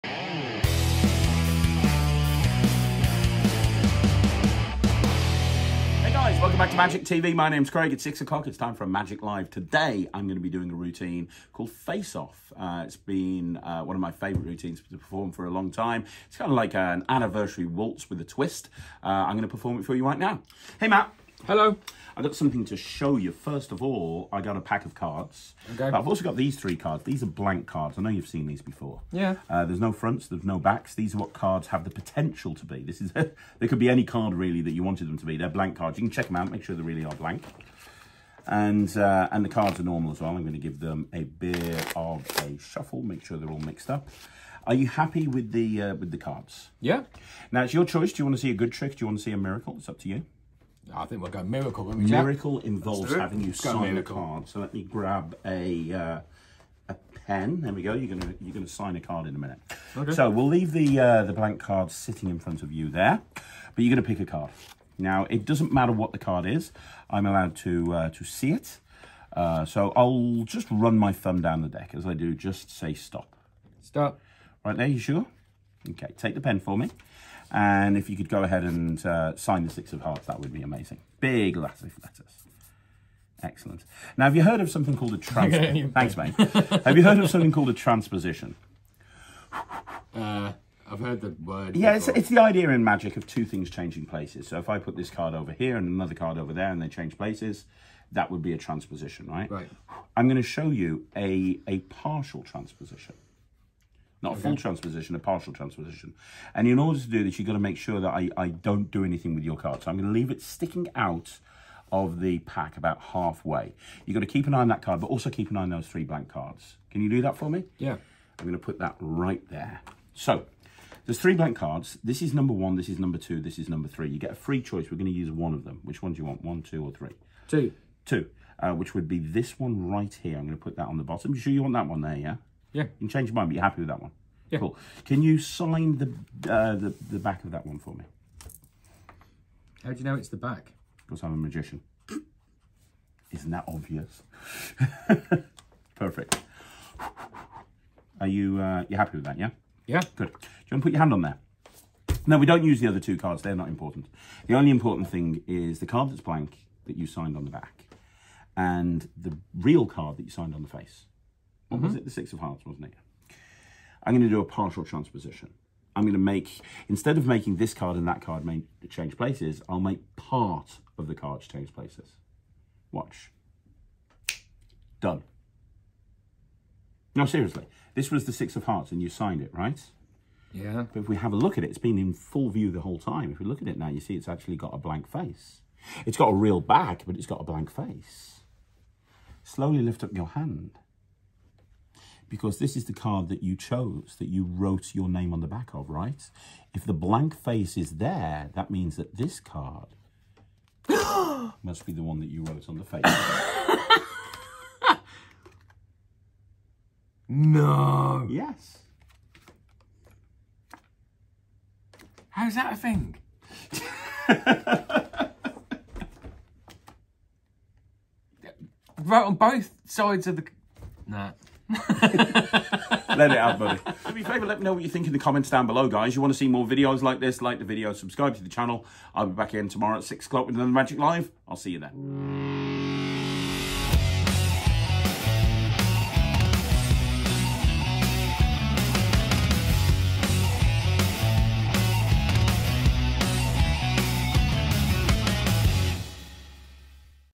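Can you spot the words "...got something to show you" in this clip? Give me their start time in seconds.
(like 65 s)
22 s.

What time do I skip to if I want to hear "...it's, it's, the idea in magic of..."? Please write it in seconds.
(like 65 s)
91 s.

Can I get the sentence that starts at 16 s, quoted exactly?
It's kind of like an anniversary waltz with a twist.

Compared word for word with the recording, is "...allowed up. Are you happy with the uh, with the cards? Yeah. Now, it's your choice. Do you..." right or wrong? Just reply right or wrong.
wrong.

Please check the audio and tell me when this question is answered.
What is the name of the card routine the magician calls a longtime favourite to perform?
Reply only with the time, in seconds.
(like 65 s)
11 s.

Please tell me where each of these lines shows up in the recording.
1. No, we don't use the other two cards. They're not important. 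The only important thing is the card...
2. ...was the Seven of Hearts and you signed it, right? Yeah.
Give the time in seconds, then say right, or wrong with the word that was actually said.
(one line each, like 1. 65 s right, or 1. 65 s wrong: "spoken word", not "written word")
1. 152 s right
2. 178 s wrong: "Six", not "Seven".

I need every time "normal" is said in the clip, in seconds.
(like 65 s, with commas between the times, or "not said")
39 s.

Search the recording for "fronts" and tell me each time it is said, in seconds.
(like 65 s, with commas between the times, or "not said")
29 s, 62 s.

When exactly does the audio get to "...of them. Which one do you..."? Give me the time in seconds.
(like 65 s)
125 s.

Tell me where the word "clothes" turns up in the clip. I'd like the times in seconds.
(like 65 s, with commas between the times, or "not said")
not said.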